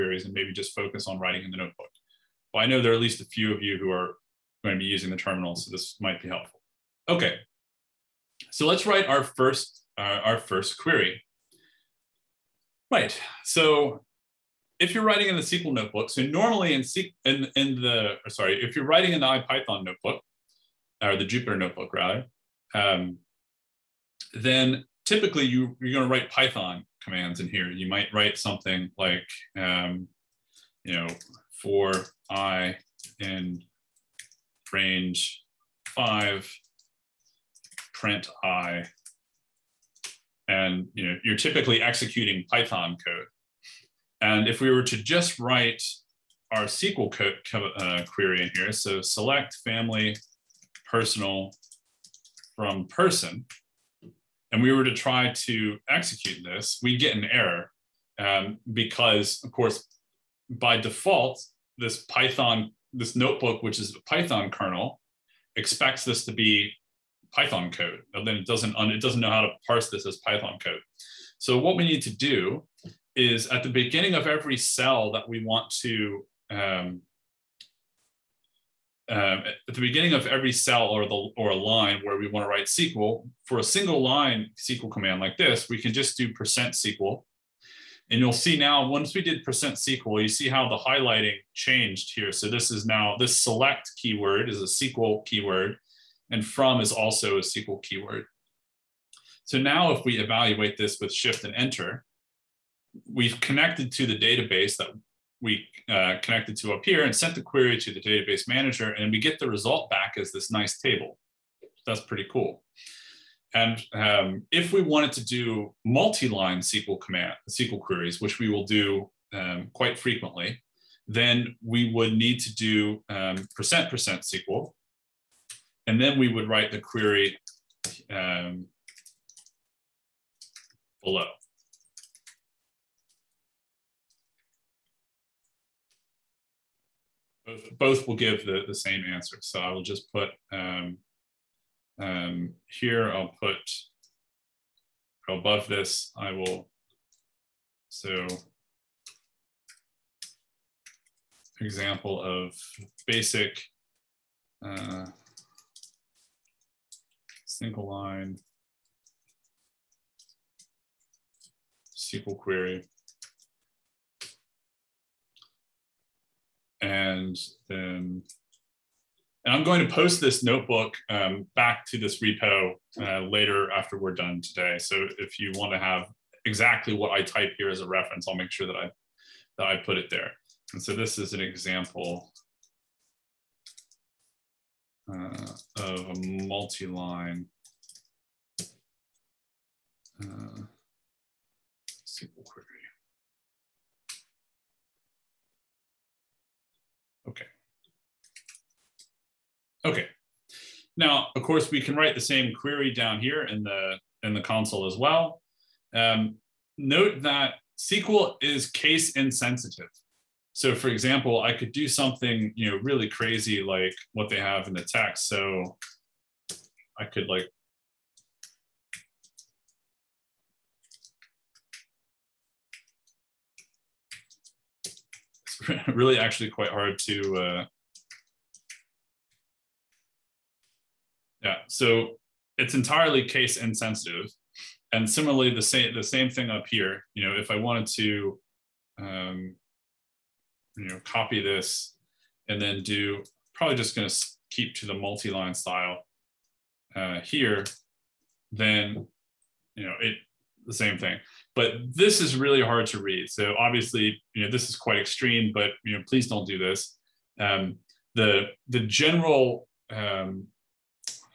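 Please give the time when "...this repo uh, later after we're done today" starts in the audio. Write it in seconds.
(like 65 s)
171 s.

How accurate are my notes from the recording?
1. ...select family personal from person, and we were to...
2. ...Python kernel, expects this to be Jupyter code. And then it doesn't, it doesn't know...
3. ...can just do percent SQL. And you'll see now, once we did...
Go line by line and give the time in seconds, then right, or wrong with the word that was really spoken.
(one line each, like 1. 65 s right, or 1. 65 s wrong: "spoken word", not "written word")
1. 49 s right
2. 64 s wrong: "Python", not "Jupyter"
3. 85 s right.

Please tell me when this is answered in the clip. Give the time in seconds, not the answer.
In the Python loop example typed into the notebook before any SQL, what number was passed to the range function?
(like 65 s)
35 s.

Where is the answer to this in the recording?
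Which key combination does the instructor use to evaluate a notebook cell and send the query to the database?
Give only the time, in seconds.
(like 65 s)
101 s.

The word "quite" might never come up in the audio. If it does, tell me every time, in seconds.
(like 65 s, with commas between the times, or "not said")
119 s, 226 s, 254 s.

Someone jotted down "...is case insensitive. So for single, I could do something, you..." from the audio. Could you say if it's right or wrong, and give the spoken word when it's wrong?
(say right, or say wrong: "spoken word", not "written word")
wrong: "example", not "single".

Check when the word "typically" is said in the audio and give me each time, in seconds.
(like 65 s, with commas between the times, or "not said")
25 s, 41 s.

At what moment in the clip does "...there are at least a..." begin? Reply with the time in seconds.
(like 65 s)
2 s.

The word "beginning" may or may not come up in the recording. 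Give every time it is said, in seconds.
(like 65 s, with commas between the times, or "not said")
73 s, 79 s.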